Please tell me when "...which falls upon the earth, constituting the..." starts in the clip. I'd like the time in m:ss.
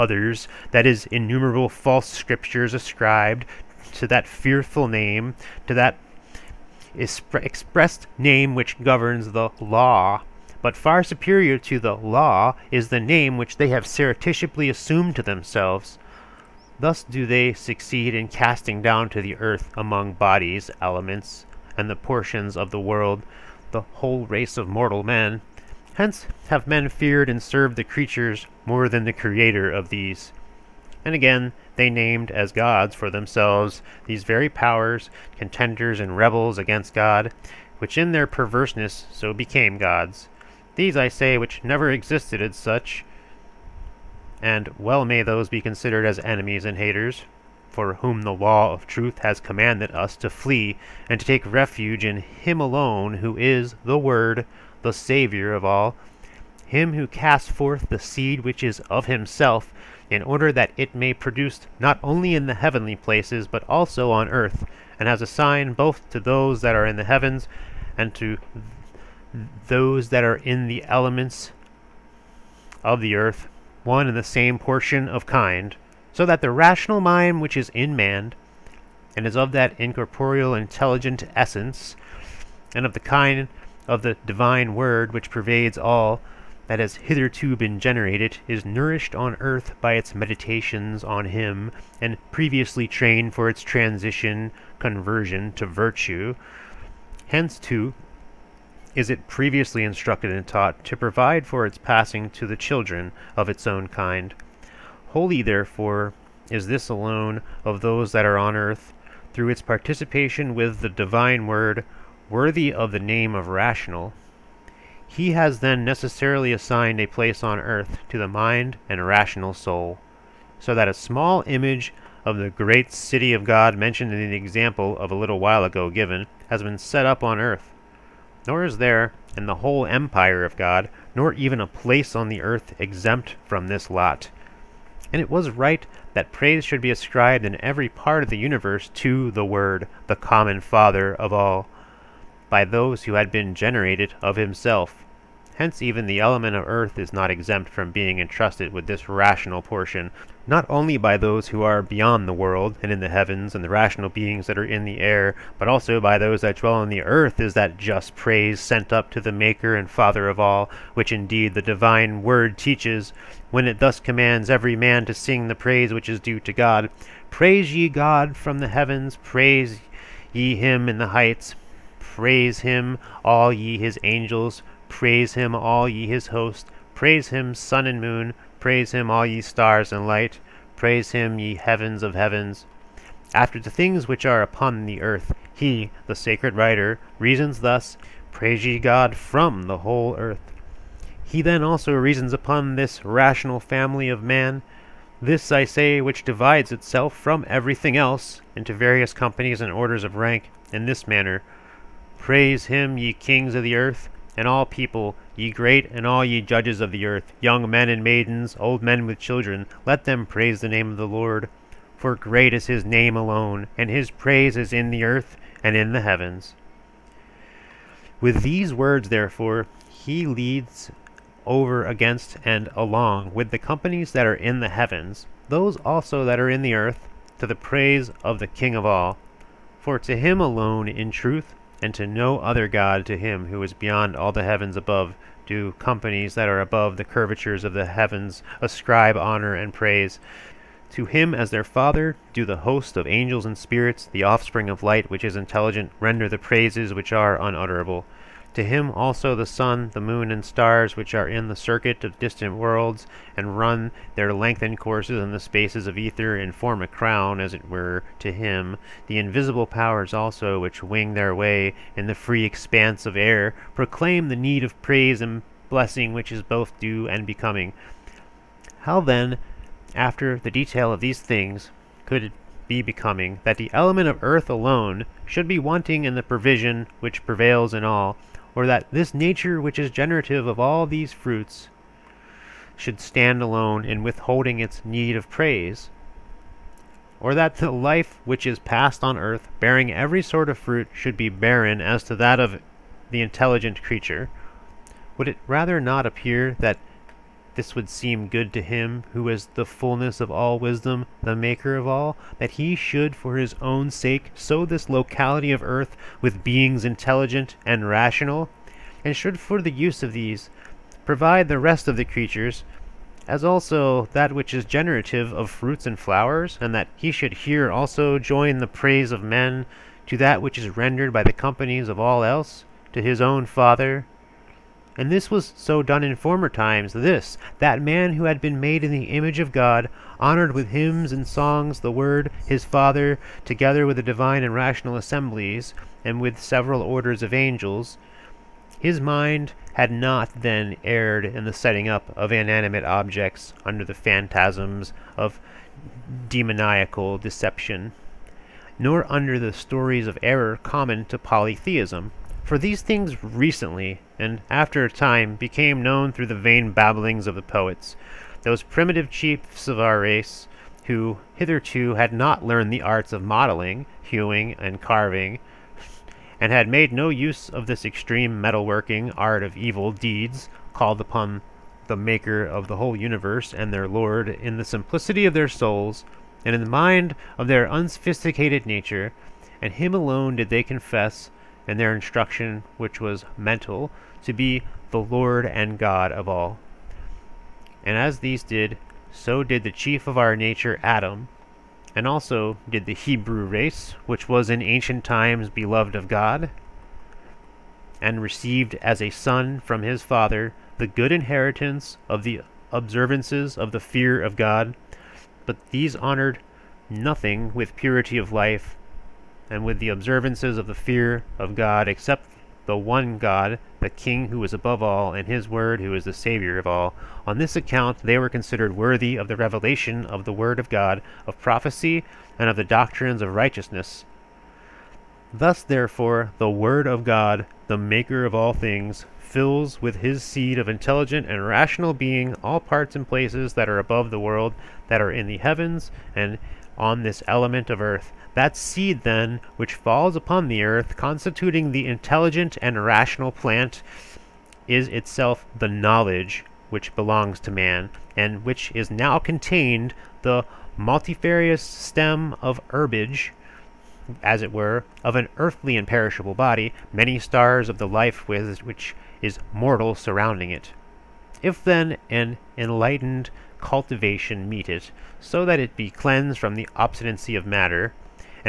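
7:19.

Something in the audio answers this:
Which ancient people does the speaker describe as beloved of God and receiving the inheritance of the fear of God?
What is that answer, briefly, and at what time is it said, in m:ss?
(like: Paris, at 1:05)
The Hebrew race, at 6:32.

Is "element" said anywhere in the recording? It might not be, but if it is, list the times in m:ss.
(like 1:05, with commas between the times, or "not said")
0:20, 1:10, 2:26, 4:33, 7:17.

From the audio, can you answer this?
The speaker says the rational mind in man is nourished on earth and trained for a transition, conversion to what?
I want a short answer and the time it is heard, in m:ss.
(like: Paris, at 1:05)
Virtue, at 1:35.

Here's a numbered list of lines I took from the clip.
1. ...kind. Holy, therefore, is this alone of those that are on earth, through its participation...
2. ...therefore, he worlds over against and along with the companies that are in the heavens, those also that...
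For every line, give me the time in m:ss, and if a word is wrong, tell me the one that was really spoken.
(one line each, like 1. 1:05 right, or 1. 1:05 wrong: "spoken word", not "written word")
1. 1:43 right
2. 3:39 wrong: "leads", not "worlds".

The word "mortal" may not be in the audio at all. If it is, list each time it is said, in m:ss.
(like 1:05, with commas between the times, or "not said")
0:24, 7:39.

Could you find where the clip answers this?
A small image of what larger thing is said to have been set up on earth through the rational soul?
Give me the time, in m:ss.
2:02.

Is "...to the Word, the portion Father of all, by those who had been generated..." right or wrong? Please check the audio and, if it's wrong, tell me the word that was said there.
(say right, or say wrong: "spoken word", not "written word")
wrong: "common", not "portion".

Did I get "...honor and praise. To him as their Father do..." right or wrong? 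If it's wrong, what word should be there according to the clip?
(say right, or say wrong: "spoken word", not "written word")
right.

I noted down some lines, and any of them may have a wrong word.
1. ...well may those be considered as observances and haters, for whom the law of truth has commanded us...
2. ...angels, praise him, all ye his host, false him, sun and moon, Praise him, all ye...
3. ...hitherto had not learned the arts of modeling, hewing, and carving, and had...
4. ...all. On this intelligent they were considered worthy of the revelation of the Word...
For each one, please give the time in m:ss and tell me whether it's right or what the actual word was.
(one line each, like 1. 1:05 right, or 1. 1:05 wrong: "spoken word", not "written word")
1. 0:44 wrong: "enemies", not "observances"
2. 2:54 wrong: "praise", not "false"
3. 6:01 right
4. 6:56 wrong: "account", not "intelligent".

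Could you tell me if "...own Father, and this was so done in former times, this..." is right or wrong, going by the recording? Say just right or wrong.
right.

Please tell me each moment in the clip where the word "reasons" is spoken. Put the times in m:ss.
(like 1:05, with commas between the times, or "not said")
3:07, 3:11.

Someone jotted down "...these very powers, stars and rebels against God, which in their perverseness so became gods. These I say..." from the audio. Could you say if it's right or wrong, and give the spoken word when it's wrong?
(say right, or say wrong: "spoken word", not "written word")
wrong: "contenders", not "stars".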